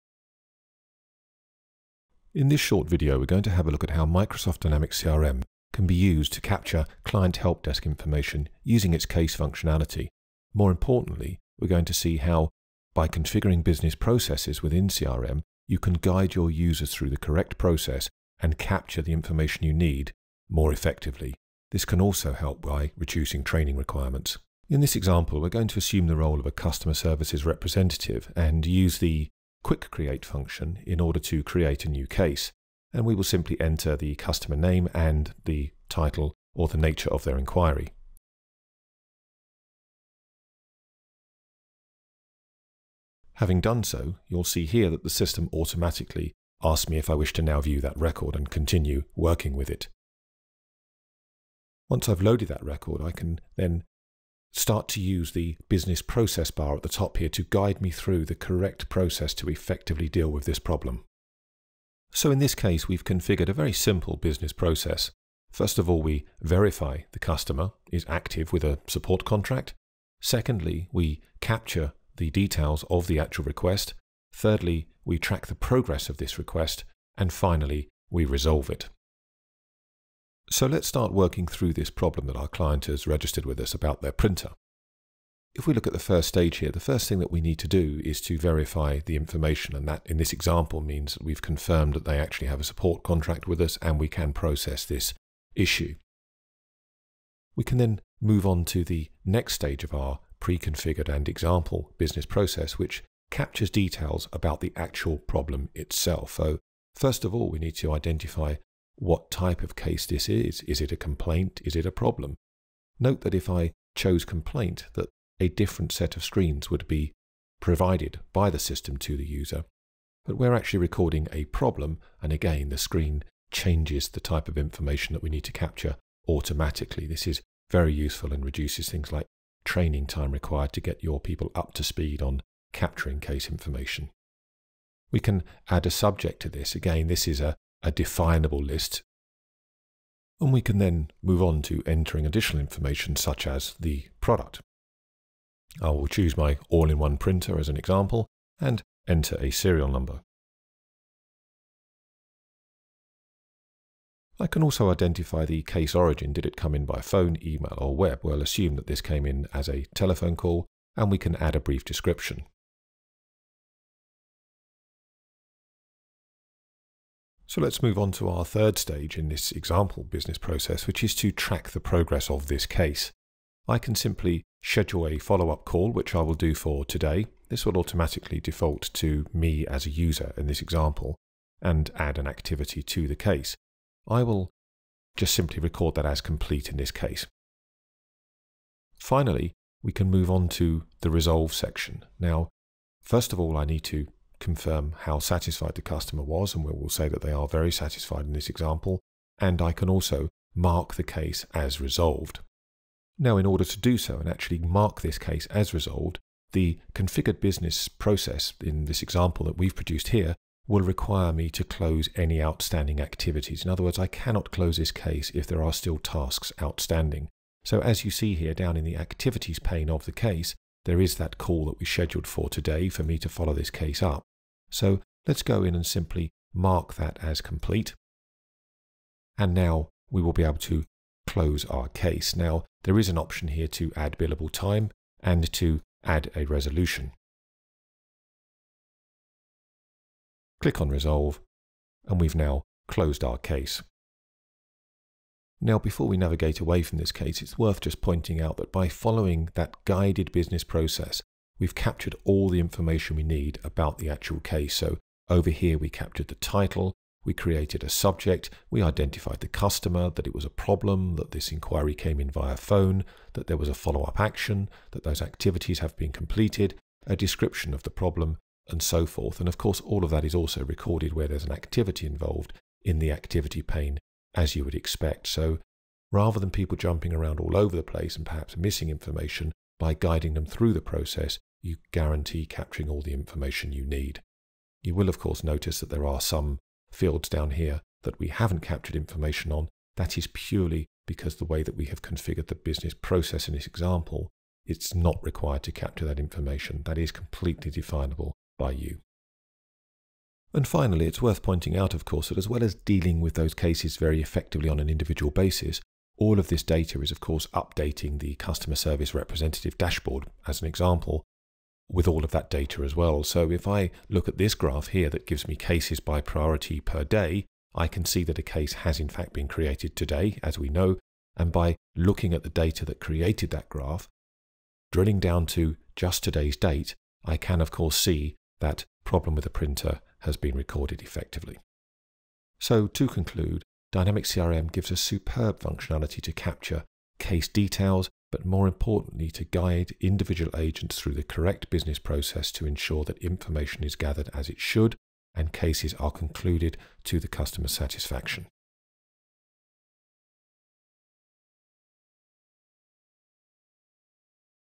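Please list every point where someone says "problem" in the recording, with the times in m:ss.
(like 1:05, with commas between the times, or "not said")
1:00, 1:21, 1:45, 1:51, 2:01, 4:20, 4:27, 5:29.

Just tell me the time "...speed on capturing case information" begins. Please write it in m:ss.
2:11.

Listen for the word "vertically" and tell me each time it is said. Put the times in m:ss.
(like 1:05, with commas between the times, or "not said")
not said.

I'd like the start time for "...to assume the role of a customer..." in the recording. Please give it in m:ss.
0:25.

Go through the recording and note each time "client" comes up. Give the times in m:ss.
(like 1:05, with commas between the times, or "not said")
0:07, 1:22.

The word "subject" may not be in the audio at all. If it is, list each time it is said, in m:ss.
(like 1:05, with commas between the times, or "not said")
2:15, 4:17.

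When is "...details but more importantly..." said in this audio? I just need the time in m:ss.
5:37.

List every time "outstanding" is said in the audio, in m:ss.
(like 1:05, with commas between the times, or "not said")
3:32, 3:36.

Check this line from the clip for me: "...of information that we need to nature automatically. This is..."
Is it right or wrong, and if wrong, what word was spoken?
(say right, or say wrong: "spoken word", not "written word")
wrong: "capture", not "nature".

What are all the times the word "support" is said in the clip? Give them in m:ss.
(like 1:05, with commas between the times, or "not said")
1:08, 1:32.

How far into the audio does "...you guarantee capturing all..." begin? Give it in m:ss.
4:41.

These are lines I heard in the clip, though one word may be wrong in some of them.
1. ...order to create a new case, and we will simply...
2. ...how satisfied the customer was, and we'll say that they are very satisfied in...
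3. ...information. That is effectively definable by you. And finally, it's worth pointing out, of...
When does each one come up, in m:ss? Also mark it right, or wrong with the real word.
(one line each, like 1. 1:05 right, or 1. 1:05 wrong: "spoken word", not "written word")
1. 0:30 right
2. 3:15 right
3. 4:56 wrong: "completely", not "effectively".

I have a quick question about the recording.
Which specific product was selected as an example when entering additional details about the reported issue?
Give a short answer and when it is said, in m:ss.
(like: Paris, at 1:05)
all-in-one printer, at 2:26.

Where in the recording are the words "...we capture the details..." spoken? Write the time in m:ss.
1:10.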